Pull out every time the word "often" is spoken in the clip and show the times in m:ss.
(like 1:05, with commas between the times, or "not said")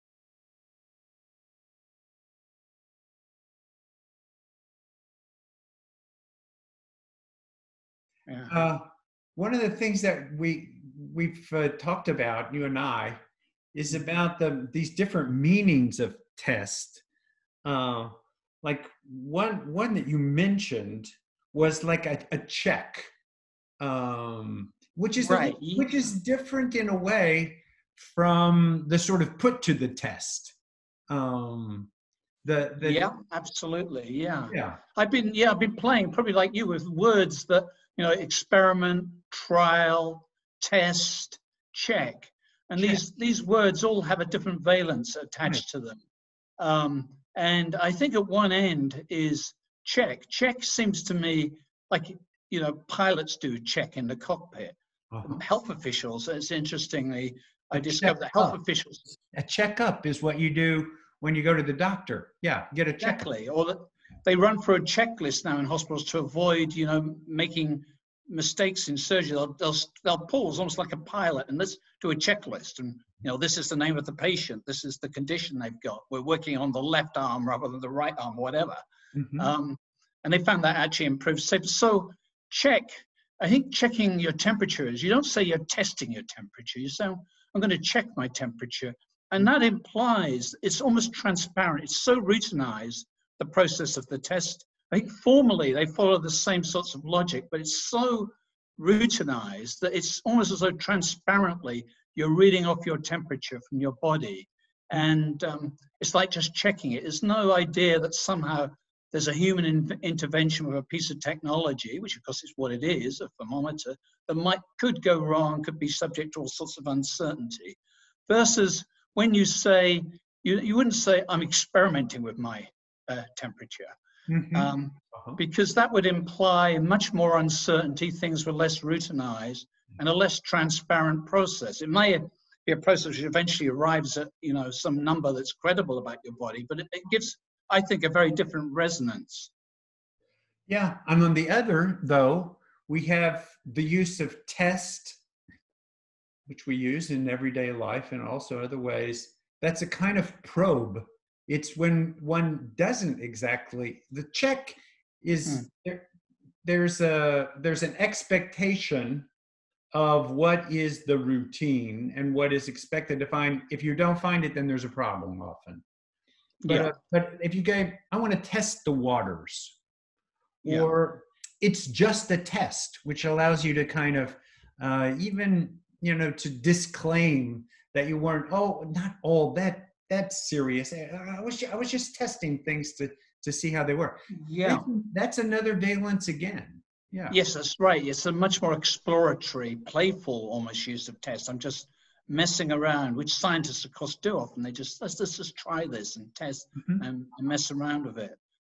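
2:45, 3:14.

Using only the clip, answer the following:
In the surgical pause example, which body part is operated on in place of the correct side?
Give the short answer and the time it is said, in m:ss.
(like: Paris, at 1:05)
left arm, at 1:16.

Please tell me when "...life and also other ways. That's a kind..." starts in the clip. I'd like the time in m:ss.
2:27.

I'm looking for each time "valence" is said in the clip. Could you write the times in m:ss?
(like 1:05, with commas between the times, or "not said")
0:44, 3:05.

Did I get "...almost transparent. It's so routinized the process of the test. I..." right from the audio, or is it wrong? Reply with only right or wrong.
right.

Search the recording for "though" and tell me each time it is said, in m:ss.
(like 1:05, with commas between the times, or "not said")
1:40, 2:22.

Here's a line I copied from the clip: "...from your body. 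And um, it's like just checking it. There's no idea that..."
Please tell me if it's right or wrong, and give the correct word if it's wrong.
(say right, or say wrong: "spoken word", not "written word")
right.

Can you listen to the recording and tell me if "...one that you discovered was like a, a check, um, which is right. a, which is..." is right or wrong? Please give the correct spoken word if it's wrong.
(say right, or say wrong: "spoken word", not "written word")
wrong: "mentioned", not "discovered".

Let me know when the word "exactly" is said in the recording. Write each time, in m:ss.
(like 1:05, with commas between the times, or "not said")
1:03, 2:33.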